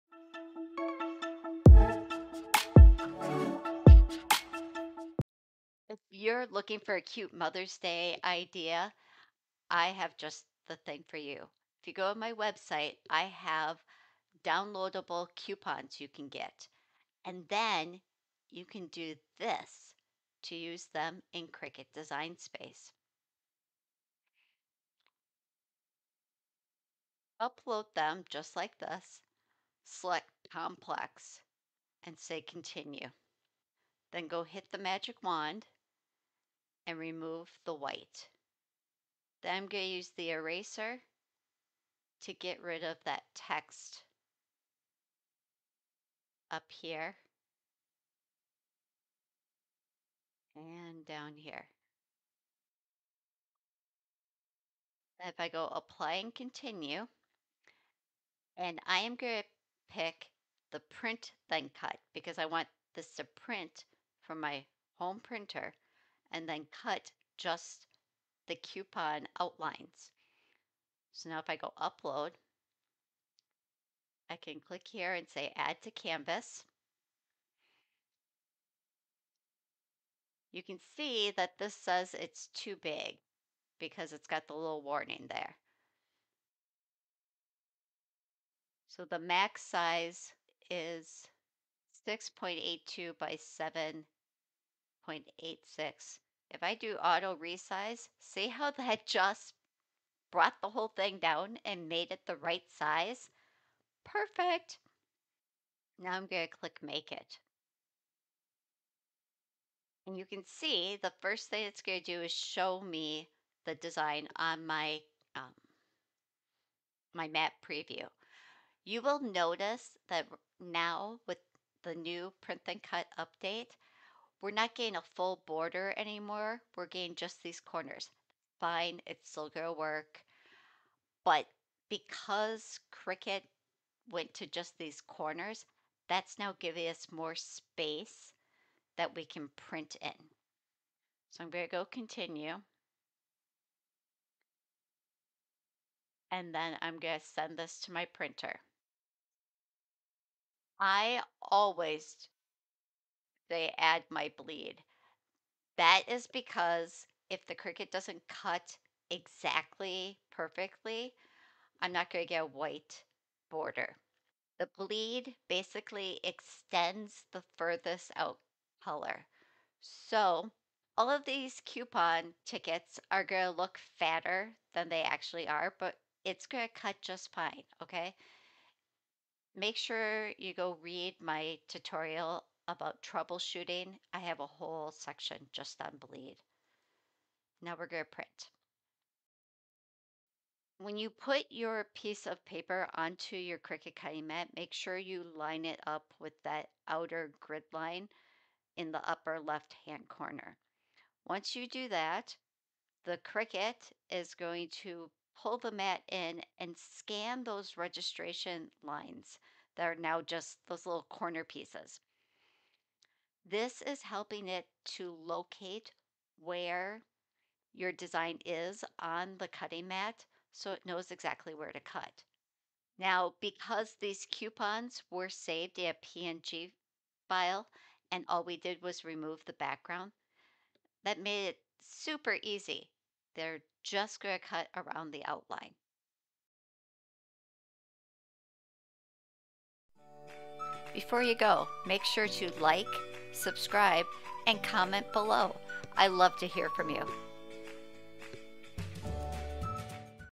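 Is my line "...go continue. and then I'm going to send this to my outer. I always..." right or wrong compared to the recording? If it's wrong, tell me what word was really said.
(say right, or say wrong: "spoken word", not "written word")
wrong: "printer", not "outer".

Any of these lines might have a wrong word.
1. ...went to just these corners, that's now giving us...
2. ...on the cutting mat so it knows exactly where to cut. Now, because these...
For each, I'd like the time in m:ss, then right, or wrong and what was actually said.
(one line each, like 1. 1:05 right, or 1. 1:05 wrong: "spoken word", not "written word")
1. 2:14 right
2. 3:38 right.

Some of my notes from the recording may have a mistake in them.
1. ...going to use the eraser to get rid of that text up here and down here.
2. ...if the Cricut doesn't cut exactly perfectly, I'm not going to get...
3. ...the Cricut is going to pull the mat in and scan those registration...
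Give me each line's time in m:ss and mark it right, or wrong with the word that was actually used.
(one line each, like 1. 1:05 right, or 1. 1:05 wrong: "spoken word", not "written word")
1. 0:39 right
2. 2:37 right
3. 3:23 right.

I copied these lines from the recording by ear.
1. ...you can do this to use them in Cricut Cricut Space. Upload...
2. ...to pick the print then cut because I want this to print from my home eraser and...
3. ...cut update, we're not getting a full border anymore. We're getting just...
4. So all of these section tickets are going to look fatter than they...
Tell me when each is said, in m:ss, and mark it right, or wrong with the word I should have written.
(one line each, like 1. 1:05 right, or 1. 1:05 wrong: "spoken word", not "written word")
1. 0:18 wrong: "Design", not "Cricut"
2. 0:59 wrong: "printer", not "eraser"
3. 2:02 right
4. 2:49 wrong: "coupon", not "section".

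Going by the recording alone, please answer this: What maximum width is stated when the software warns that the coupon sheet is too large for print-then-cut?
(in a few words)
6.82.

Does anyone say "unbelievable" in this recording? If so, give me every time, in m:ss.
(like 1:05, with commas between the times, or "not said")
not said.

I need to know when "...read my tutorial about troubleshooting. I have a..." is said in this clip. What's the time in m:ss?
3:00.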